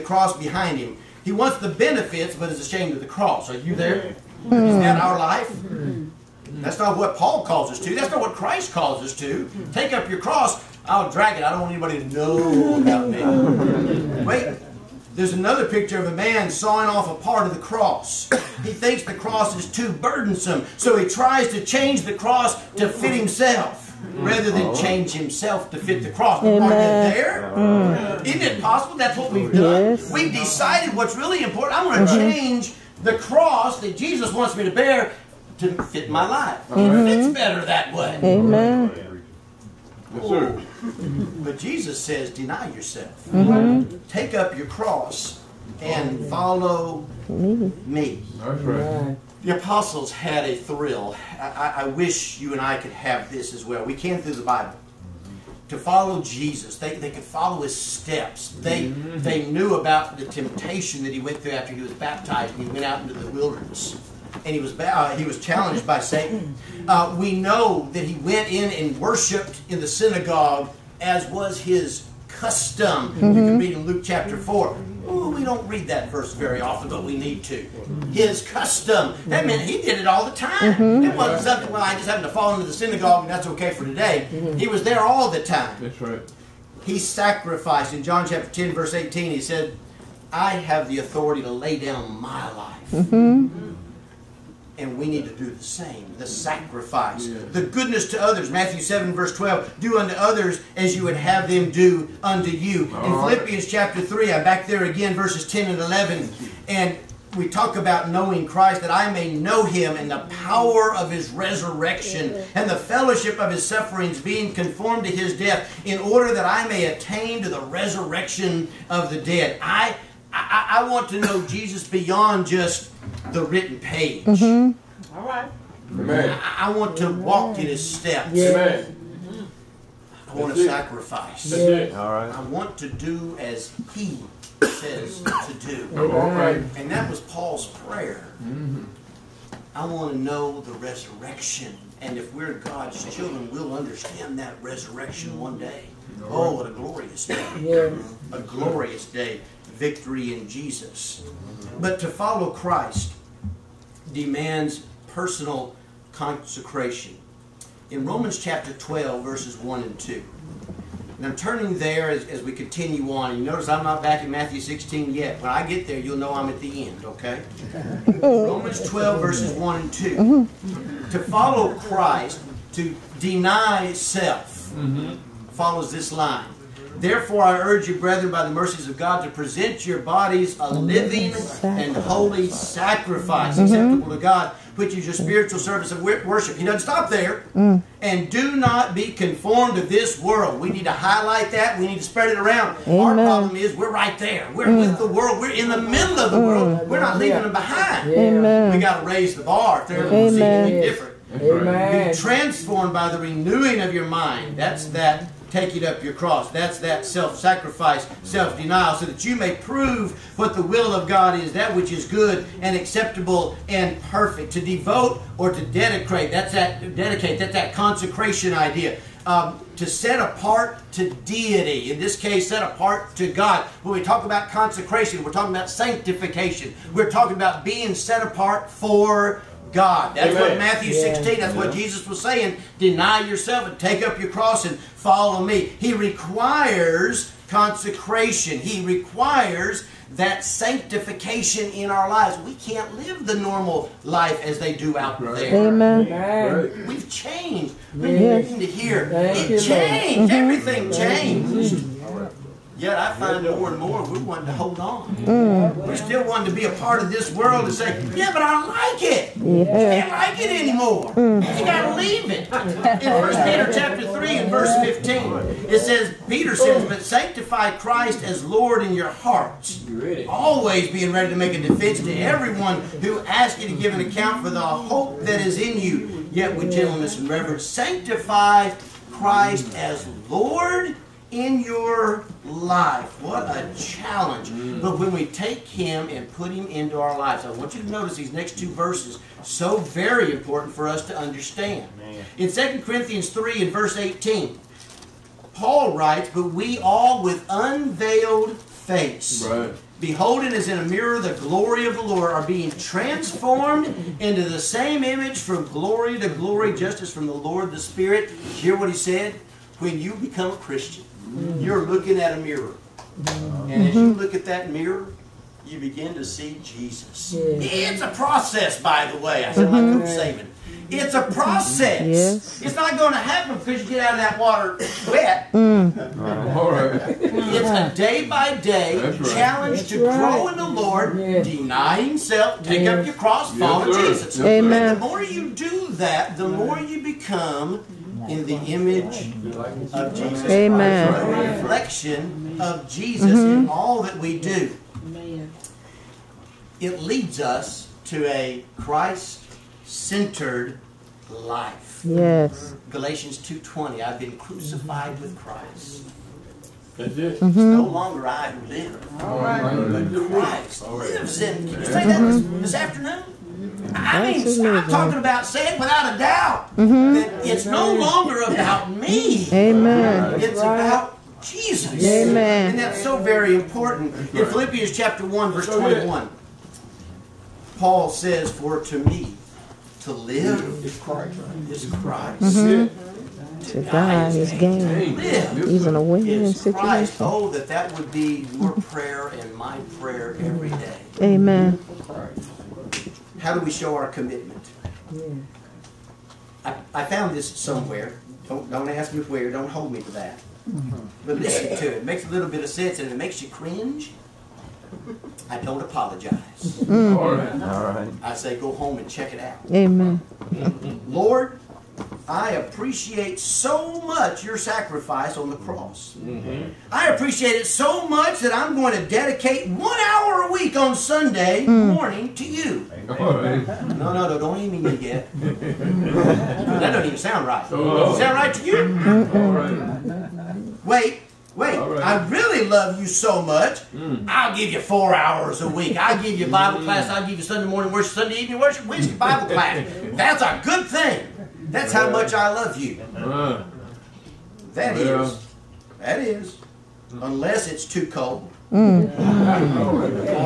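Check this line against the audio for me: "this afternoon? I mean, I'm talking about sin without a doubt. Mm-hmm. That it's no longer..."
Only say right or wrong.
right.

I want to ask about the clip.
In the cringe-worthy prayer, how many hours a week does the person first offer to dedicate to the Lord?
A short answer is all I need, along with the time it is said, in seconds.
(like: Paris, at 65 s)
1, at 419 s.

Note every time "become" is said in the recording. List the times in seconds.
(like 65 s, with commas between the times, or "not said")
310 s, 337 s.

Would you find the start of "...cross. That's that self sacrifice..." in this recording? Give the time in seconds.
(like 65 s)
206 s.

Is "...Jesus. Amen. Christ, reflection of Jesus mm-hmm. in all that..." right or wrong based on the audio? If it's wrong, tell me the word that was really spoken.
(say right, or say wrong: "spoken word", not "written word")
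right.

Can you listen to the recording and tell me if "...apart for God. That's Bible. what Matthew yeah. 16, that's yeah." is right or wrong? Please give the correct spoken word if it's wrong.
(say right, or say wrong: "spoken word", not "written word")
wrong: "Amen", not "Bible".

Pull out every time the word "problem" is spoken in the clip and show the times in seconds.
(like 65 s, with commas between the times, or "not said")
193 s.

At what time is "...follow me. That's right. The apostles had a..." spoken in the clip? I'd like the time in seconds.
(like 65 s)
46 s.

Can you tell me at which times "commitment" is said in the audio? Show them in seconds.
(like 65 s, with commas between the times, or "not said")
394 s.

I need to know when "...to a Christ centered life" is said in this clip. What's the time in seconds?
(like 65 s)
348 s.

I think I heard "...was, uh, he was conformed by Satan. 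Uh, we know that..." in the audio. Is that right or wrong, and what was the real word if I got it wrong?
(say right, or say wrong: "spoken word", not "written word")
wrong: "challenged", not "conformed".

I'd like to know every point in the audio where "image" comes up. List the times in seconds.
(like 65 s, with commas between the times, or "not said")
305 s, 338 s.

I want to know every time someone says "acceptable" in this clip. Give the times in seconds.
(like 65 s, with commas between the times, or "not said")
183 s, 212 s.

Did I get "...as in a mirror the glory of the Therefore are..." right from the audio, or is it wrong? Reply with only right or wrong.
wrong.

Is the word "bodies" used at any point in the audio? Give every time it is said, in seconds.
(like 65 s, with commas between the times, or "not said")
179 s.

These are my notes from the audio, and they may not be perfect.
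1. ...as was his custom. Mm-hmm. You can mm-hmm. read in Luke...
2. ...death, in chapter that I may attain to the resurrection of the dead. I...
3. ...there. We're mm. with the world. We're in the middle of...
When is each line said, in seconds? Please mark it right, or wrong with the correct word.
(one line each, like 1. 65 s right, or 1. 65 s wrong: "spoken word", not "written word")
1. 71 s right
2. 115 s wrong: "order", not "chapter"
3. 194 s right.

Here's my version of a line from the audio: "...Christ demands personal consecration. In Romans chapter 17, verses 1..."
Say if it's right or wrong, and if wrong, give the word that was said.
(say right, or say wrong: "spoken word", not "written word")
wrong: "12", not "17".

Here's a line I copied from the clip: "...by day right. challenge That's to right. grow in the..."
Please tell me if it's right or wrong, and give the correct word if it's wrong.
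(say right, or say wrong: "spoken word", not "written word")
right.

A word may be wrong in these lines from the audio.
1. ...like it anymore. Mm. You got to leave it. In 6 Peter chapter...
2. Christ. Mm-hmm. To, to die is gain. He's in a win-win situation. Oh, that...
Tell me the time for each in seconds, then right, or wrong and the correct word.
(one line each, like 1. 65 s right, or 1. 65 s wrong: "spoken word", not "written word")
1. 260 s wrong: "1", not "6"
2. 382 s right.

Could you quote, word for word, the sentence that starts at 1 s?
He wants the benefits, but is ashamed of the cross.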